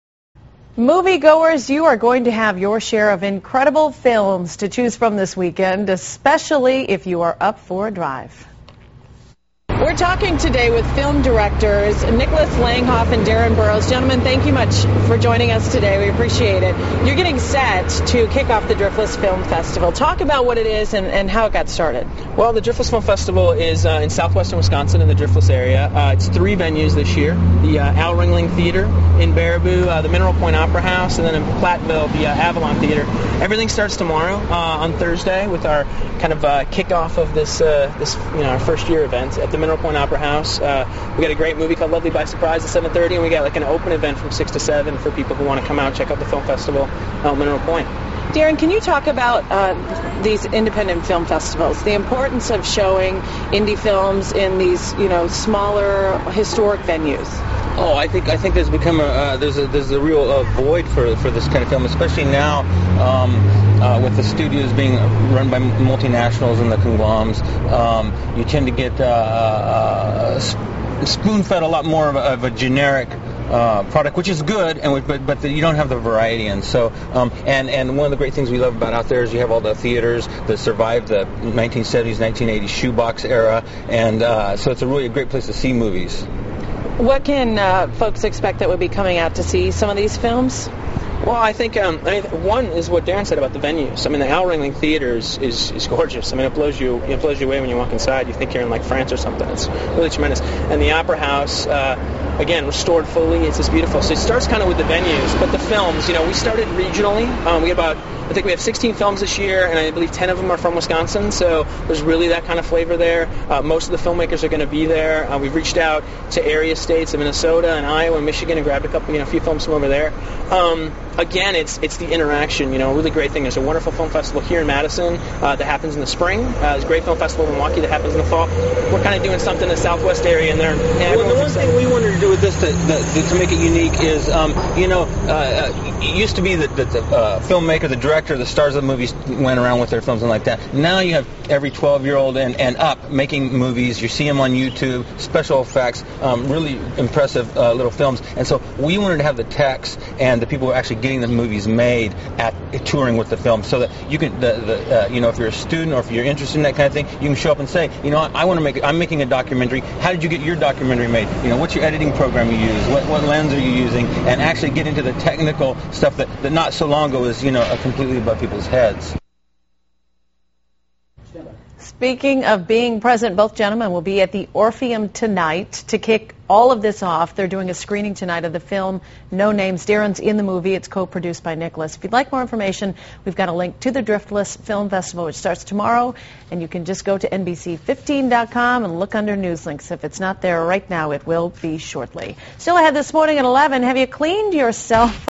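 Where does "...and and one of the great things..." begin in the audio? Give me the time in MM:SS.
01:17.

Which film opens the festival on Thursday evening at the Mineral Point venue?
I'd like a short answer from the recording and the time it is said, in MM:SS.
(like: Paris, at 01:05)
Lovely by Surprise, at 00:41.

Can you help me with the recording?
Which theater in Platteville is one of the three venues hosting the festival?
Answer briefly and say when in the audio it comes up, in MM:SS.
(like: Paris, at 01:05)
Avalon Theater, at 00:32.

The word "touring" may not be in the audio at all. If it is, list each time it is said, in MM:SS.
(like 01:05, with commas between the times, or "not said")
02:32.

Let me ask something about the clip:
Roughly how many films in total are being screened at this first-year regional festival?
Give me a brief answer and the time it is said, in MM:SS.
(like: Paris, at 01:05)
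16, at 01:48.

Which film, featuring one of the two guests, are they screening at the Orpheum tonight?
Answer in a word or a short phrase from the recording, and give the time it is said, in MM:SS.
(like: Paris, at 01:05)
No Names, at 02:59.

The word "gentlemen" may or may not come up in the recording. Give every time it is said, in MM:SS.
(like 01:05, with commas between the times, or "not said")
00:13, 02:53.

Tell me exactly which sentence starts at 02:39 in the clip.
How did you get your documentary made?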